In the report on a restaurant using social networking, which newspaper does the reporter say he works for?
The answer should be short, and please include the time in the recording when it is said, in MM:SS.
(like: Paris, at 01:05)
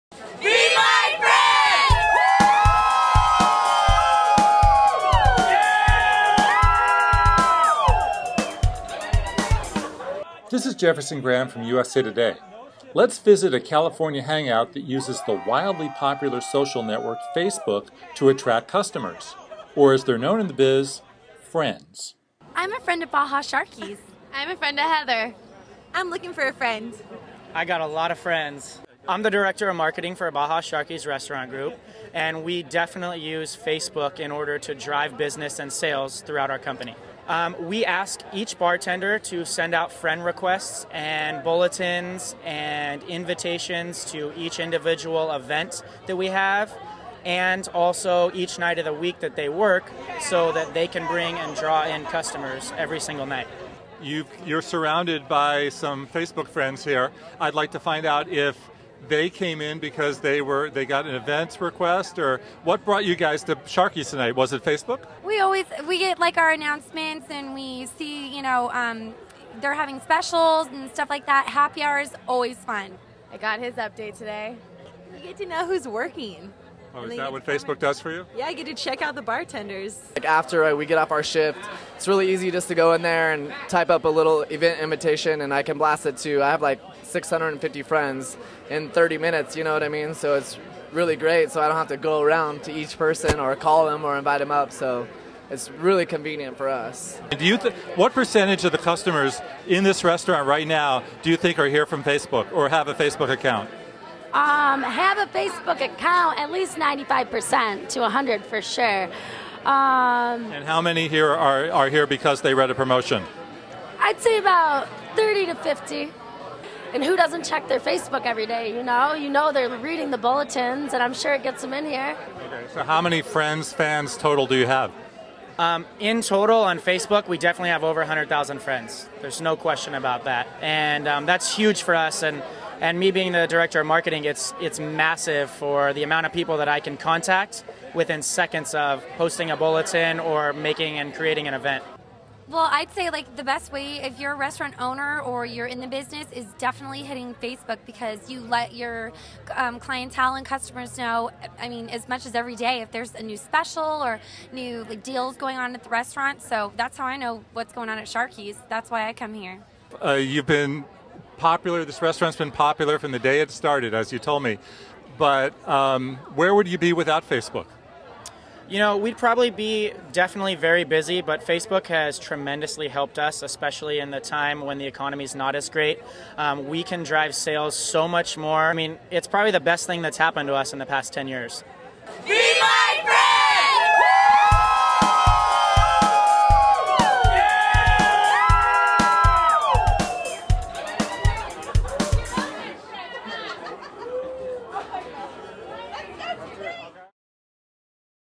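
USA Today, at 00:11.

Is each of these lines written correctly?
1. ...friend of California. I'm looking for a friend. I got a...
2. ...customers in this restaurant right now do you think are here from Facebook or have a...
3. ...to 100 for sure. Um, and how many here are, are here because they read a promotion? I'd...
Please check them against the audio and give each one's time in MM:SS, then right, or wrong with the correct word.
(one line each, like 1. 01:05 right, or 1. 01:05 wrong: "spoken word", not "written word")
1. 00:24 wrong: "Heather", not "California"
2. 01:38 right
3. 01:47 right.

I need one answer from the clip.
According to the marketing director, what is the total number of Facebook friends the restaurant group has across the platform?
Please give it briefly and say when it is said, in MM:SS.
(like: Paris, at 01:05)
over 100,000, at 02:07.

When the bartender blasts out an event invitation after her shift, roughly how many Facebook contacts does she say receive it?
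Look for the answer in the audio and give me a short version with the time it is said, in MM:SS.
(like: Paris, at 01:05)
650, at 01:27.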